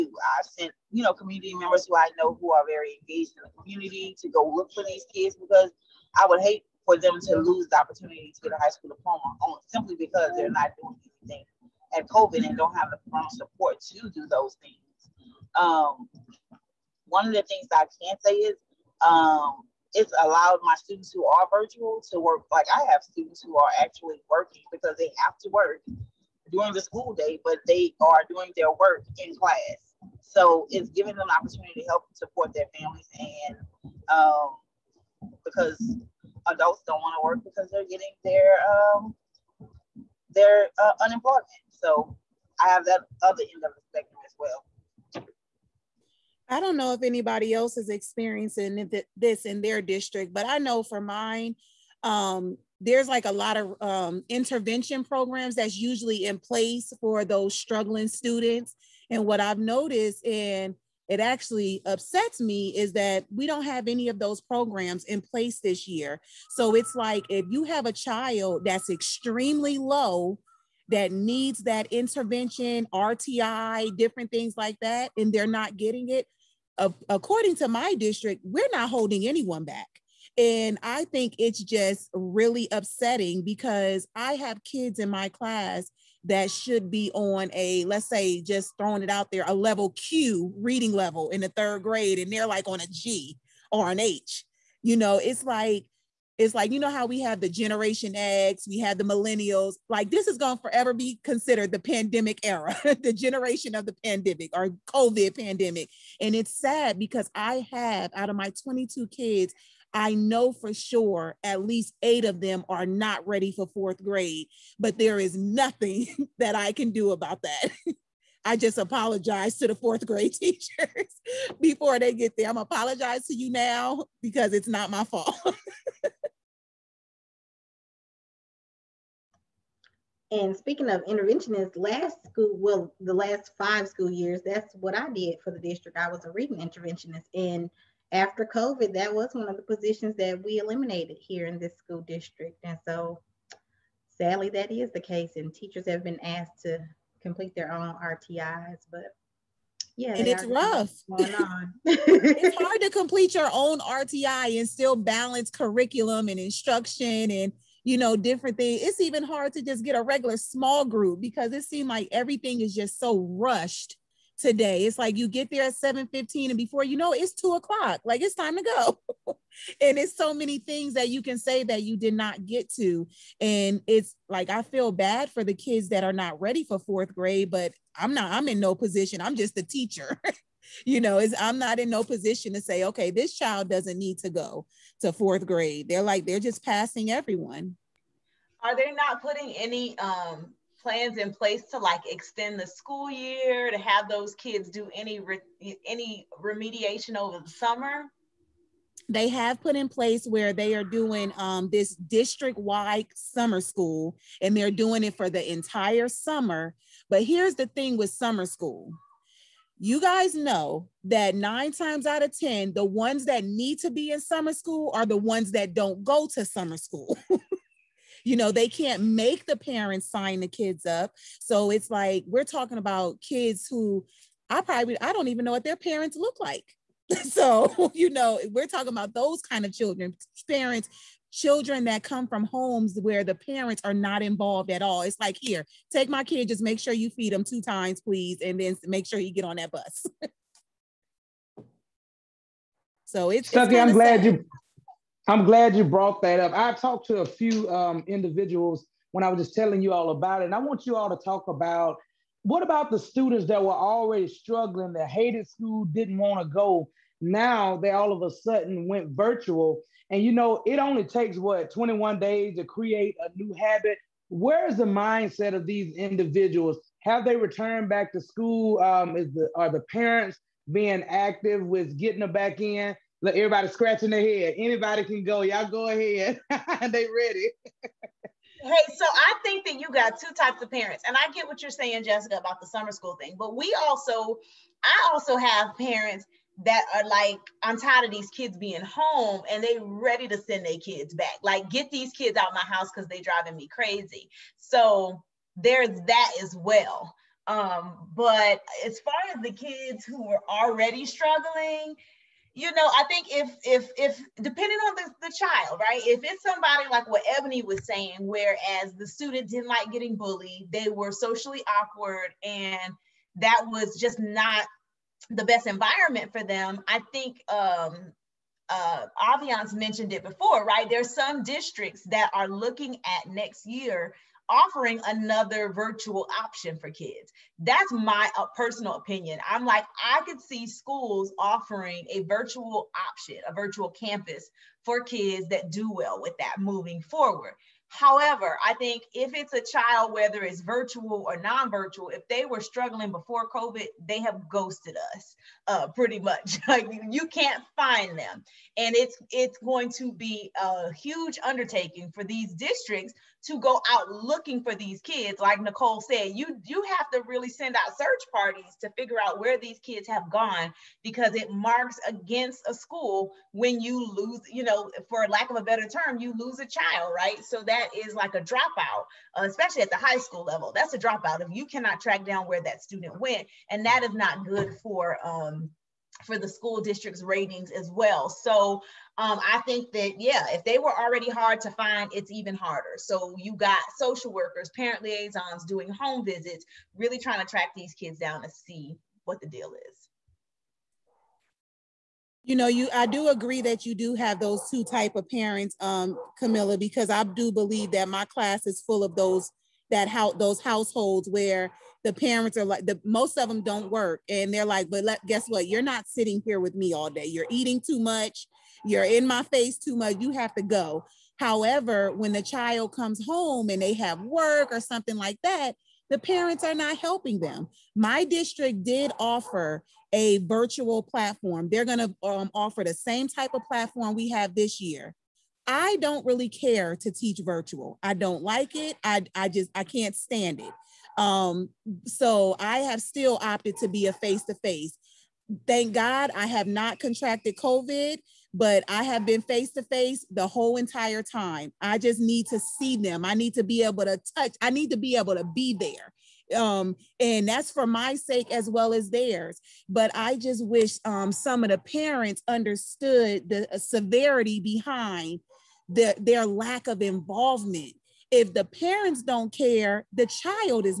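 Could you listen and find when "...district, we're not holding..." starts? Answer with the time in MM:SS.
01:17.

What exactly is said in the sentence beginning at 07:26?
Um, and that's for my sake as well as theirs.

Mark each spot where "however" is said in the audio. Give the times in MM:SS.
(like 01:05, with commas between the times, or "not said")
05:37, 06:51.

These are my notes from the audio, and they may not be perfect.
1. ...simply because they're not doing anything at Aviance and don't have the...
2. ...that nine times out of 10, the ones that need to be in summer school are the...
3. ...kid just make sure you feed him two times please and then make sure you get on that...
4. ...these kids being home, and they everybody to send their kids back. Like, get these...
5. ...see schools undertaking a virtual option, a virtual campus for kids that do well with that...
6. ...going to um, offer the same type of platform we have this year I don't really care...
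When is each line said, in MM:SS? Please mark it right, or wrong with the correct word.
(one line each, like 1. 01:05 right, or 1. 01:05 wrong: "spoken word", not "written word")
1. 00:09 wrong: "COVID", not "Aviance"
2. 03:31 right
3. 03:56 right
4. 04:48 wrong: "ready", not "everybody"
5. 05:30 wrong: "offering", not "undertaking"
6. 07:01 right.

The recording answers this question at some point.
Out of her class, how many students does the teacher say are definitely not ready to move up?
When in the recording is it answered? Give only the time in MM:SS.
01:52.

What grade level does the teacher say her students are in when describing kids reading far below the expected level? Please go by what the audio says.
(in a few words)
third grade.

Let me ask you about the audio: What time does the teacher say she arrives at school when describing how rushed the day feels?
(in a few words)
7:15.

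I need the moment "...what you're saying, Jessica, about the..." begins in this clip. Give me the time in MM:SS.
04:41.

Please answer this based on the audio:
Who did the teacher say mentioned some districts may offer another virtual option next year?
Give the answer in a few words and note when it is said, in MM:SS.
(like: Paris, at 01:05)
Aviance, at 05:19.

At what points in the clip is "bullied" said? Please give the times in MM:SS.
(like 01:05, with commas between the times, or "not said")
05:10.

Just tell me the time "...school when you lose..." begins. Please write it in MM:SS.
06:02.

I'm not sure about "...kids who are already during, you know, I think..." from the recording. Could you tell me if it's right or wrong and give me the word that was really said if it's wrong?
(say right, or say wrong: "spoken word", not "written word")
wrong: "struggling", not "during".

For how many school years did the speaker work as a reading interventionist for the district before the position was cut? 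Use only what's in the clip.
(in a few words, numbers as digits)
5.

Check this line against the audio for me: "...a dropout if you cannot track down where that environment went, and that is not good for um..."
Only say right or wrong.
wrong.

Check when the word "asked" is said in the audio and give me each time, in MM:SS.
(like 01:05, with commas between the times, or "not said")
02:26.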